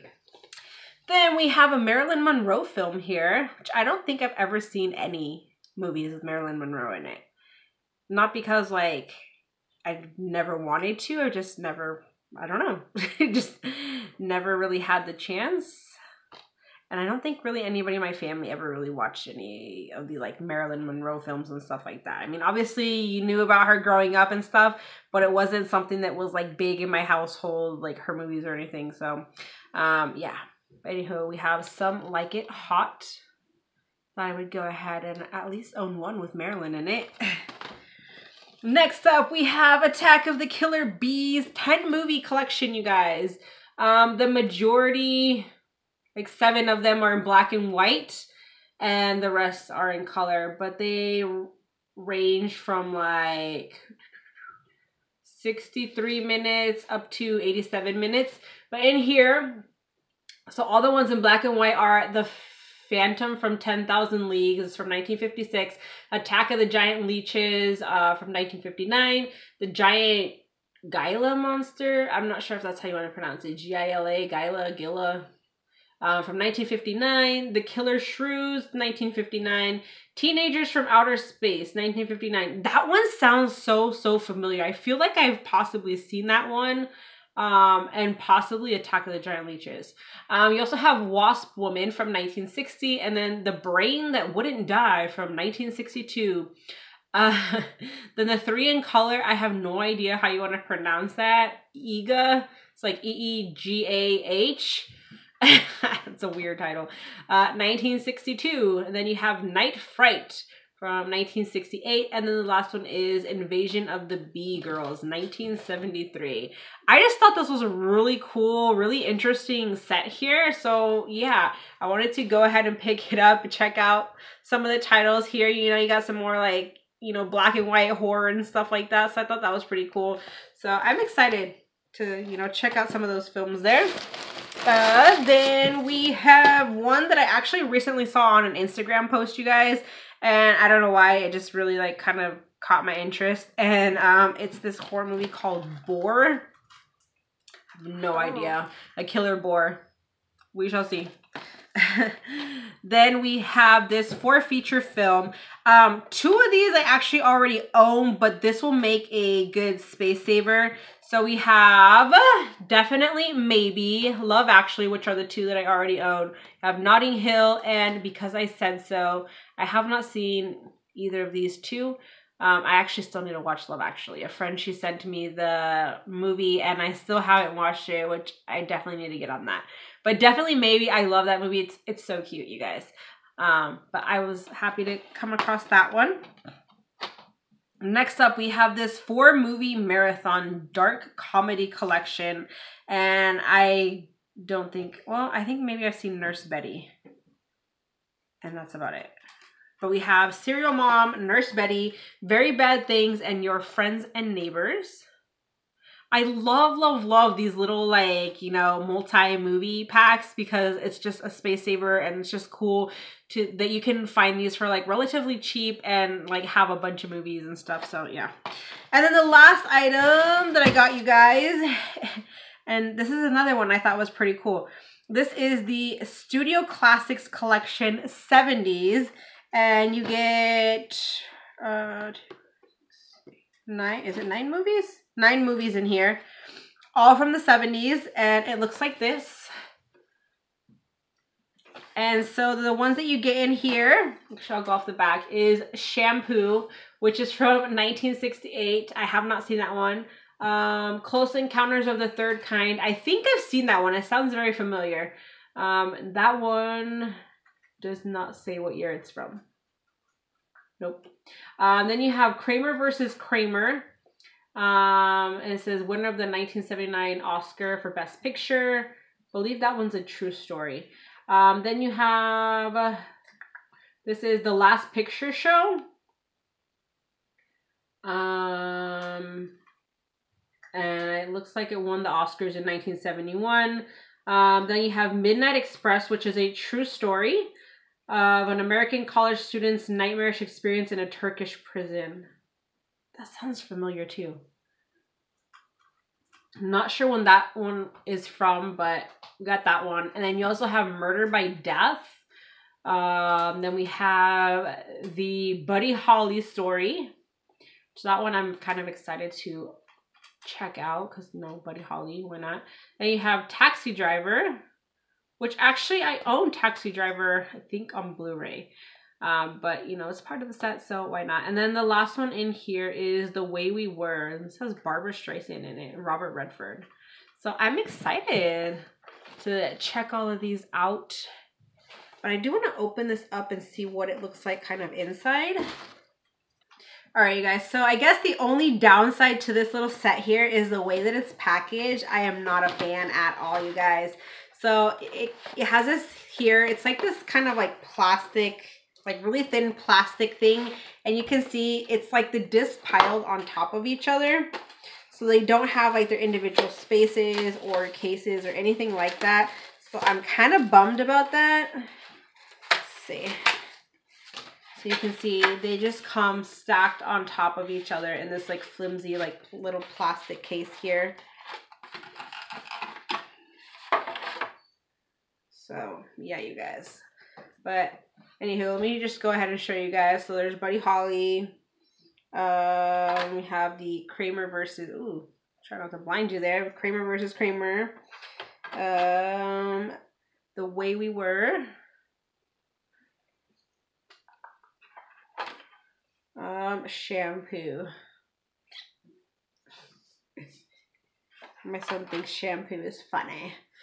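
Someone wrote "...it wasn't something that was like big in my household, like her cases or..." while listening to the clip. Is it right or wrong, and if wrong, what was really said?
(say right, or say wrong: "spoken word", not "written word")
wrong: "movies", not "cases".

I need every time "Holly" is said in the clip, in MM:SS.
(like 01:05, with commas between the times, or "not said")
05:05, 05:11, 06:20.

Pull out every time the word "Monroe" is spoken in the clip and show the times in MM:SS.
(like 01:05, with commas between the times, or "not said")
00:02, 00:06, 00:20.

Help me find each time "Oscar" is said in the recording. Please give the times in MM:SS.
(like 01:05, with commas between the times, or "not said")
04:27, 04:42.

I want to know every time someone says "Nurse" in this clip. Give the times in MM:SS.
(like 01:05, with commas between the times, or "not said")
03:16, 03:21.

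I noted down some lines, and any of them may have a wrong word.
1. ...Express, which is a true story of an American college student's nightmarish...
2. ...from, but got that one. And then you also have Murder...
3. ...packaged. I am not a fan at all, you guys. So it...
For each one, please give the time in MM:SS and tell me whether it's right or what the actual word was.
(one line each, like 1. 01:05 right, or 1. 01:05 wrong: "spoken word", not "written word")
1. 04:45 right
2. 04:58 right
3. 05:41 right.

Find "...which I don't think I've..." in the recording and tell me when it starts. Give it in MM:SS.
00:03.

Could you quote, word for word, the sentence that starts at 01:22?
That one sounds so, so familiar.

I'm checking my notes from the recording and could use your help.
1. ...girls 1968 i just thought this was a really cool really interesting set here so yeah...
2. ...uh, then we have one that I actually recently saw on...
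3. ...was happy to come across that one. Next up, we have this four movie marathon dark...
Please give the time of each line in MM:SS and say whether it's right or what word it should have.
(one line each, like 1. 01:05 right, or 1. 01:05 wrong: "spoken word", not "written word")
1. 01:54 wrong: "1973", not "1968"
2. 02:14 right
3. 03:04 right.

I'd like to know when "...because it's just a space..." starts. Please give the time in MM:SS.
03:30.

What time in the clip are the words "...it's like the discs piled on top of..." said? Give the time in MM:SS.
05:51.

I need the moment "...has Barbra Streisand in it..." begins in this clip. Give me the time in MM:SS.
05:24.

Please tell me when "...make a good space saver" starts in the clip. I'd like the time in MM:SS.
02:38.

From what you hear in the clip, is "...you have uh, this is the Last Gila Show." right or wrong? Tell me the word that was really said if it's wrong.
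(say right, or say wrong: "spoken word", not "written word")
wrong: "Picture", not "Gila".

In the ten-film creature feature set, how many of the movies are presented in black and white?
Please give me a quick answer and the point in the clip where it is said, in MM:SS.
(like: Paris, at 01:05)
7, at 00:46.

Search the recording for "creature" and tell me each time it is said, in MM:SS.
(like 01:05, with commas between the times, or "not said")
not said.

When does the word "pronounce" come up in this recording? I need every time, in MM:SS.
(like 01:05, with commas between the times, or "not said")
01:13, 01:40.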